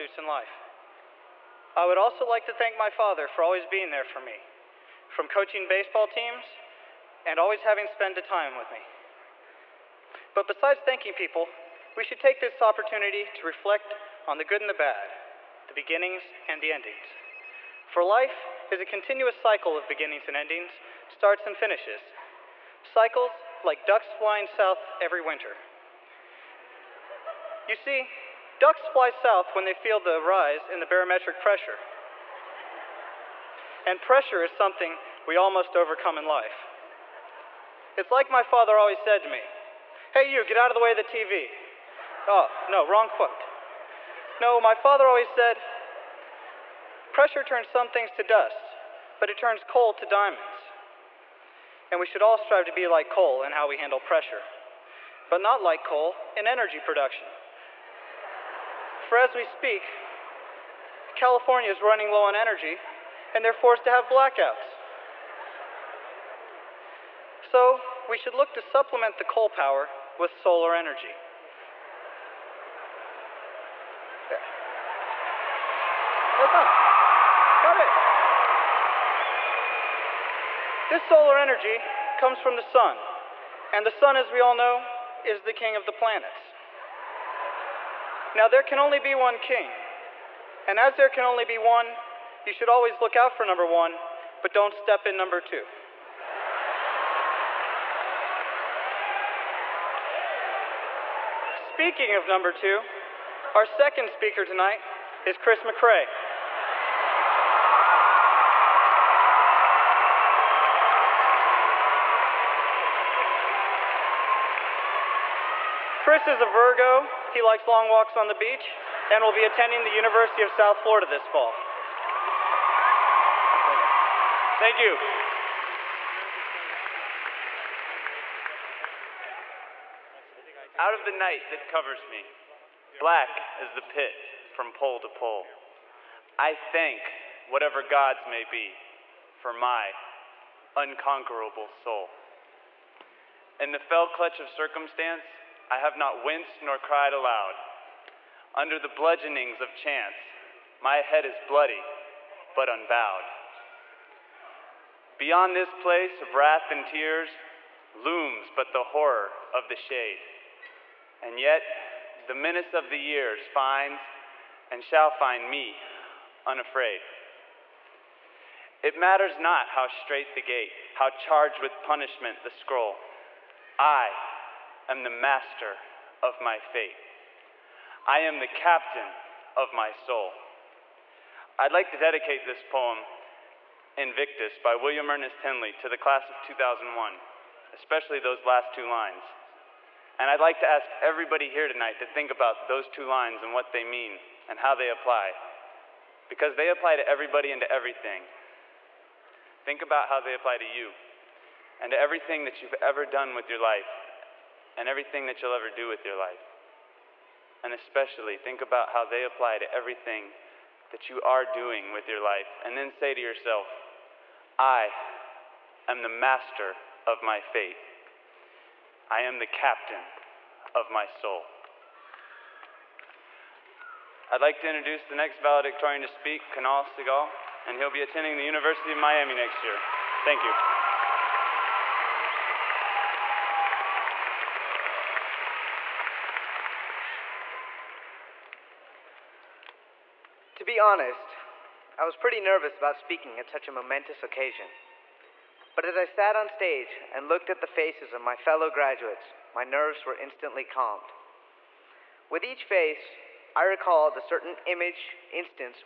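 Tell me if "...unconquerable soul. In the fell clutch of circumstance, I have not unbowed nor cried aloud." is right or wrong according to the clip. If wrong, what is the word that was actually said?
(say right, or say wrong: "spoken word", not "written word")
wrong: "winced", not "unbowed".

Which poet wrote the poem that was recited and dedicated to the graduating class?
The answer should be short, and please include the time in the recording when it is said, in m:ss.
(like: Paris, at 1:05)
William Ernest Henley, at 3:04.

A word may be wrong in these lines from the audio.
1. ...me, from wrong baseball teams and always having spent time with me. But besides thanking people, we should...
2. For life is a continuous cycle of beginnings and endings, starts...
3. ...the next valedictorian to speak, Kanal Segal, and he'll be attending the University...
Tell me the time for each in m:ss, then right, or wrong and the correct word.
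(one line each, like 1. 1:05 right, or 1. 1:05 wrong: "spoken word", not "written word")
1. 0:04 wrong: "coaching", not "wrong"
2. 0:17 right
3. 3:45 right.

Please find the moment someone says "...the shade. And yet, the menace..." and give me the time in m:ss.
2:39.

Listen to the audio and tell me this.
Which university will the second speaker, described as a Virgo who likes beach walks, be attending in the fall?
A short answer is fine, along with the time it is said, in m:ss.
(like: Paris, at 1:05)
University of South Florida, at 1:59.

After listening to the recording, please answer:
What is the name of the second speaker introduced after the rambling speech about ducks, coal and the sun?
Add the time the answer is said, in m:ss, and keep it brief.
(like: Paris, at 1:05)
Chris McRae, at 1:45.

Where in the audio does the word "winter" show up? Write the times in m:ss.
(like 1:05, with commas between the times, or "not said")
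0:25.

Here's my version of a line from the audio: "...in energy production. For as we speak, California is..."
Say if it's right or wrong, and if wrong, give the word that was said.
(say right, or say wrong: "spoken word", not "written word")
right.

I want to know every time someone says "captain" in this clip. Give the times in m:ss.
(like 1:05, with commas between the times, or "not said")
2:58, 3:39.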